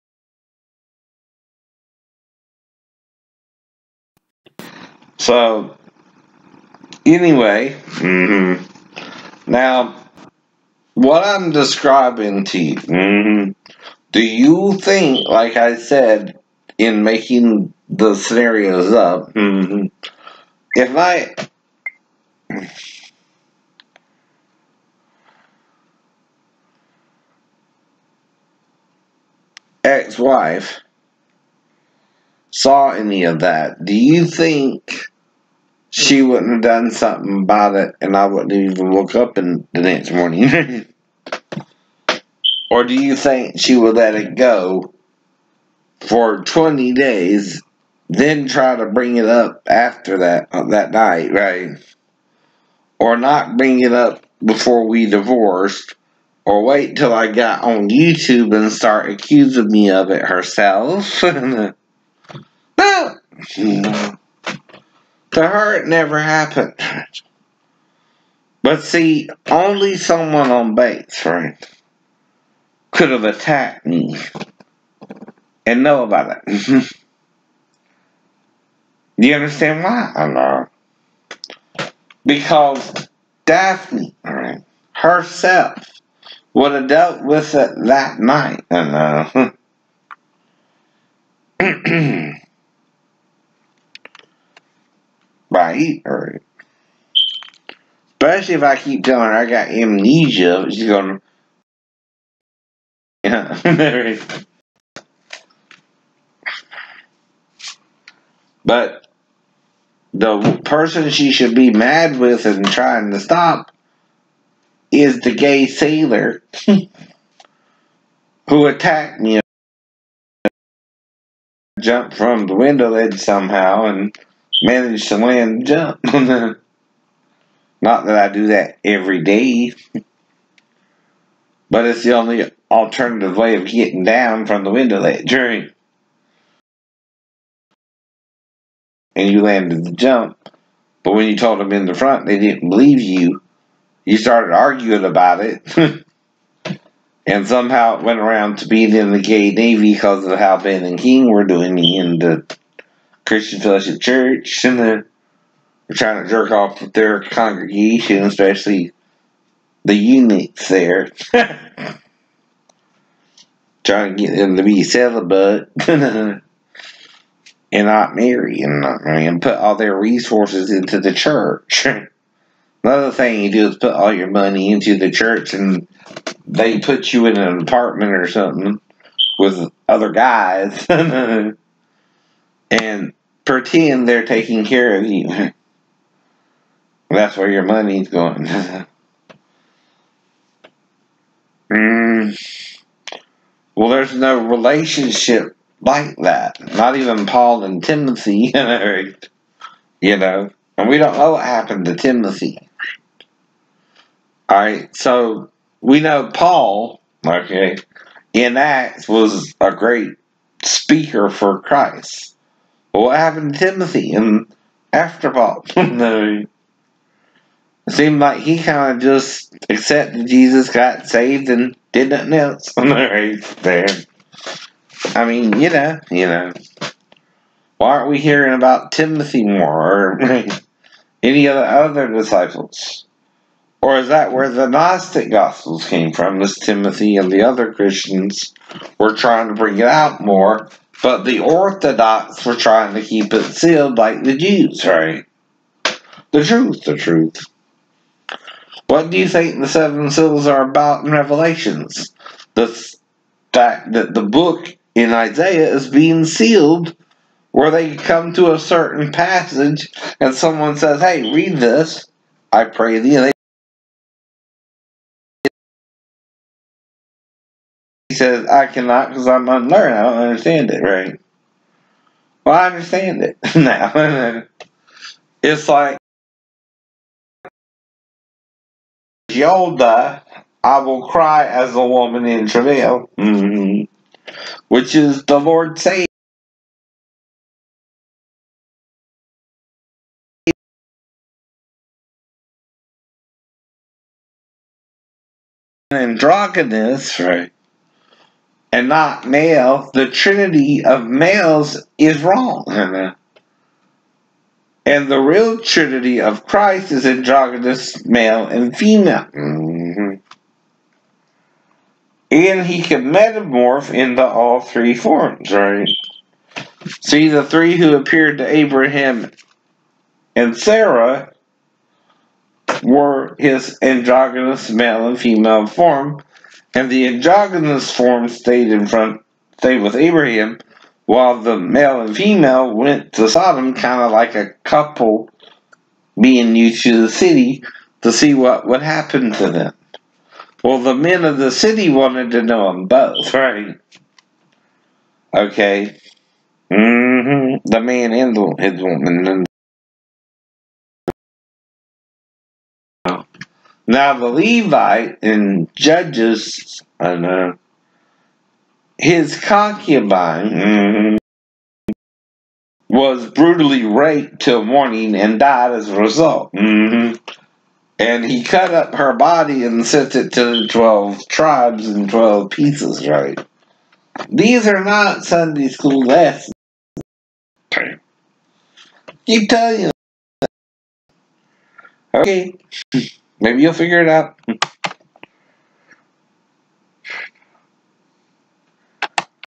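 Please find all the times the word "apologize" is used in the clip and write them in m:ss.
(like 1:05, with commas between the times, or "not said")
not said.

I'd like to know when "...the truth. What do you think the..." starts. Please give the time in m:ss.
4:06.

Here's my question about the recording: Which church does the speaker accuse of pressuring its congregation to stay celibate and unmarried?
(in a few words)
Christian Fellowship Church.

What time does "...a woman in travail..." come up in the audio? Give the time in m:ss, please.
4:41.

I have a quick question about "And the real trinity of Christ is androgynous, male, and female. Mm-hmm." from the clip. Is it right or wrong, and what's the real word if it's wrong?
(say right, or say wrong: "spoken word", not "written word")
right.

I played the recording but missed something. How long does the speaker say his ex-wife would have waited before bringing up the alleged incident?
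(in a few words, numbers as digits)
20 days.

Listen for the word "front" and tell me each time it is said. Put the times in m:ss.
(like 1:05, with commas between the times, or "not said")
2:21, 5:28.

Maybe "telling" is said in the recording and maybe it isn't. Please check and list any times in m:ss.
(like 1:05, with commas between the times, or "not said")
1:39, 6:19.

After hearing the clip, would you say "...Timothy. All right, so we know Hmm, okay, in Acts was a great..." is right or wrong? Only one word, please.
wrong.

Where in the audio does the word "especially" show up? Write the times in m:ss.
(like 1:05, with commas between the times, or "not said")
1:38, 2:38.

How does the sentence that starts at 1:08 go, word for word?
But see, only someone on Bates, right, could have attacked me and know about it.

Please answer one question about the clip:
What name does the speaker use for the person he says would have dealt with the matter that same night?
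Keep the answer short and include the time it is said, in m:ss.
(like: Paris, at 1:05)
Daphne, at 1:23.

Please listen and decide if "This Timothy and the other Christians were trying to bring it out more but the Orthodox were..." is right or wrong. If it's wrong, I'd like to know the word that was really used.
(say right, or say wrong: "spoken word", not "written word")
right.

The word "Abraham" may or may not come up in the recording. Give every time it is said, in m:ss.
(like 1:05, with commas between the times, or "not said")
5:18, 5:29.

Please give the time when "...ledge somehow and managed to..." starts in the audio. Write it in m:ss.
2:02.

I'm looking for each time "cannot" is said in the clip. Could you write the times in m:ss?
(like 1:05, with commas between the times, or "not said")
4:28.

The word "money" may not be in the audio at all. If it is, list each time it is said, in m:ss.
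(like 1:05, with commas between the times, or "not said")
2:54, 3:07.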